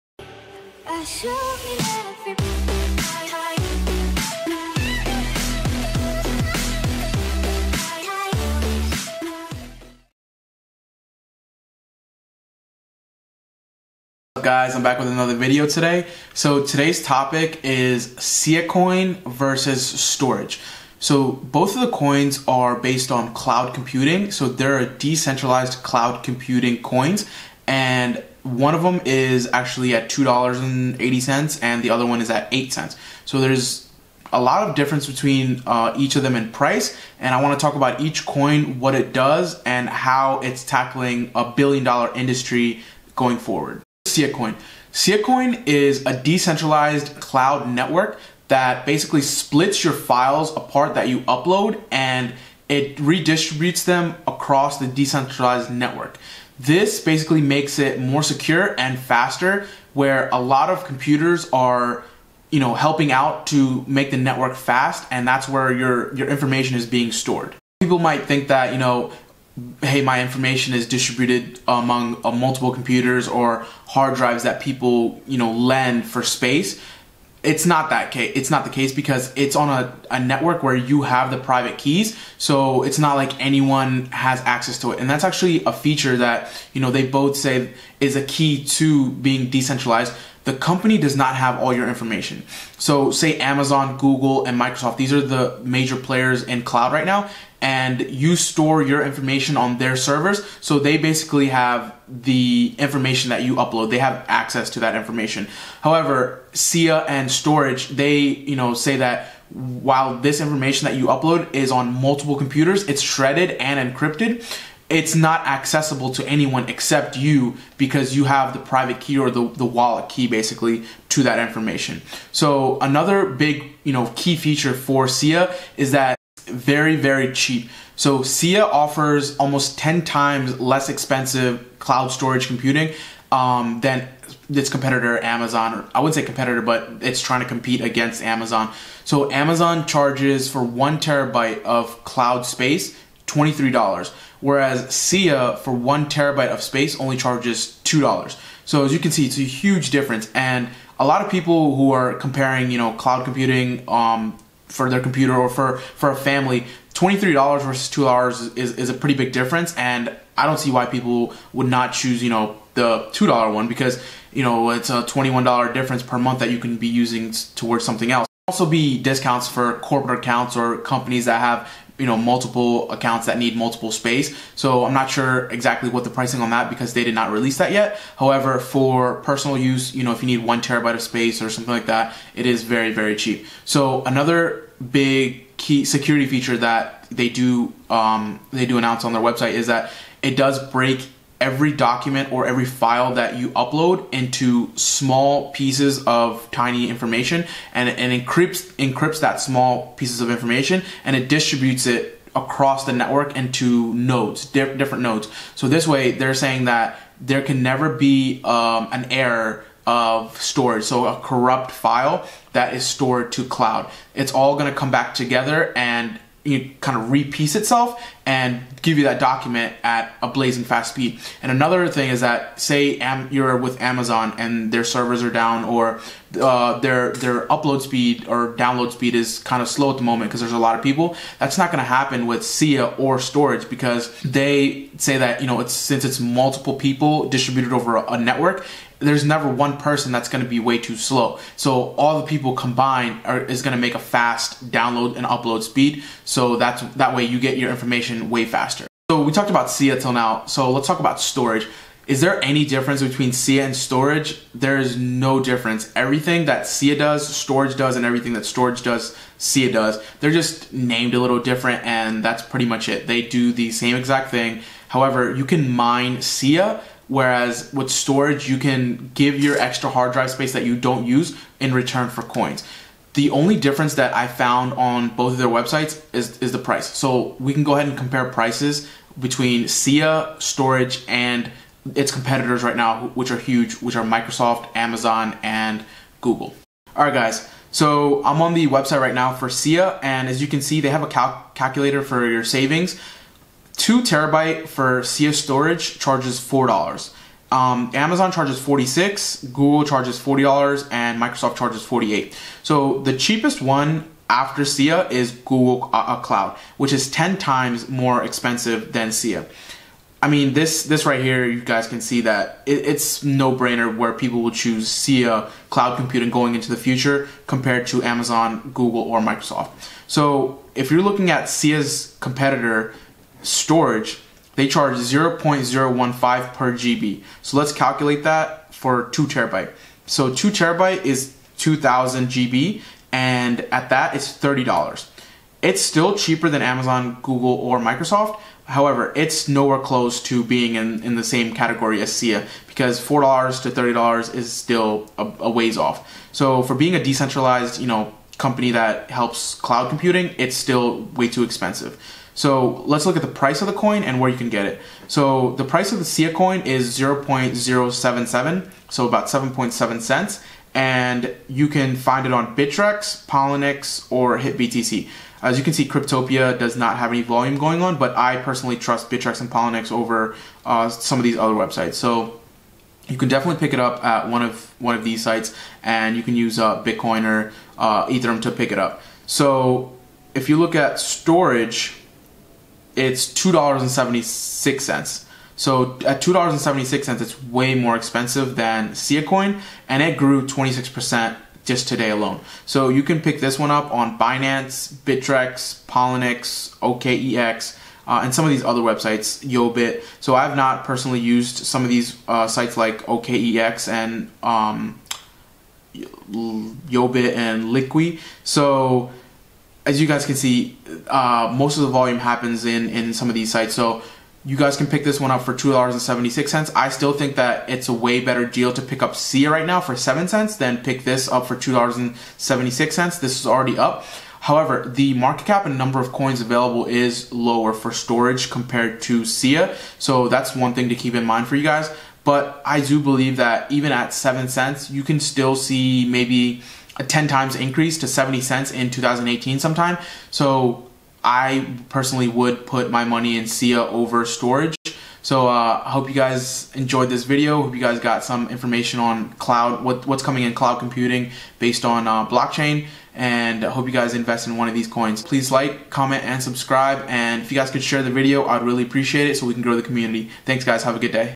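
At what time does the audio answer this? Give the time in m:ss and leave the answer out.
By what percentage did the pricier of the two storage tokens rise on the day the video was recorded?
6:30.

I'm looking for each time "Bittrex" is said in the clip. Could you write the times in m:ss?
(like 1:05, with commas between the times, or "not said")
6:02, 6:09, 6:34.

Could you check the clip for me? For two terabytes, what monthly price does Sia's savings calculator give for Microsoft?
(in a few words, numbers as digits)
48.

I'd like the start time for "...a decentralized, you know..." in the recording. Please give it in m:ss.
5:46.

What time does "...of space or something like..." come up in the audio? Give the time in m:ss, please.
3:00.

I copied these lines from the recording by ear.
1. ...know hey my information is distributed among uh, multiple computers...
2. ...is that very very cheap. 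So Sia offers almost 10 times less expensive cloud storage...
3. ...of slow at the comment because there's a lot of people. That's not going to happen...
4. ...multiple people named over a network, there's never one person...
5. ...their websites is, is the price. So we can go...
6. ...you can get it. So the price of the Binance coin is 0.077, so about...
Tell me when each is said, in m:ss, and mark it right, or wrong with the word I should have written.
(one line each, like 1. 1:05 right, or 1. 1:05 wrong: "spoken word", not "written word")
1. 1:08 right
2. 2:05 right
3. 3:49 wrong: "moment", not "comment"
4. 3:56 wrong: "distributed", not "named"
5. 4:35 right
6. 5:54 wrong: "SIA", not "Binance".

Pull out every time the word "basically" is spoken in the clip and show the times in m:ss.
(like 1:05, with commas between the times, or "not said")
0:48, 0:56, 1:40, 2:00.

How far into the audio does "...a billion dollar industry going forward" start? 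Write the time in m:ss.
0:41.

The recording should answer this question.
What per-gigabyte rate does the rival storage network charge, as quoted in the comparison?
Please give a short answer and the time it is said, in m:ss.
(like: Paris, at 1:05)
0.015, at 5:24.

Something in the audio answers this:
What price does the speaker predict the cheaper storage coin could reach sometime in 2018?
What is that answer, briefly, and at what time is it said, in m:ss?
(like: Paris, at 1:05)
70 cents, at 7:18.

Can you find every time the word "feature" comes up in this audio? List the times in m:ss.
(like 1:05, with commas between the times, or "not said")
1:25, 2:04, 3:06.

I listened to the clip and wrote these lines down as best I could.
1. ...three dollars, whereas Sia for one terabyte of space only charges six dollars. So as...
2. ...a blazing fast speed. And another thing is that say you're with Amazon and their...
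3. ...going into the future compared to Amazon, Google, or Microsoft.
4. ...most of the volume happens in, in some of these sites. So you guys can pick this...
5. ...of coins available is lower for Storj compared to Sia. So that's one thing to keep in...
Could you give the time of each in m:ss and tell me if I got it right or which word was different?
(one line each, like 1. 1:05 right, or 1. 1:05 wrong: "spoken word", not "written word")
1. 2:23 wrong: "two", not "six"
2. 3:40 right
3. 5:16 right
4. 6:51 right
5. 7:05 right.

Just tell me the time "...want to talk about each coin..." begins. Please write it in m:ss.
0:37.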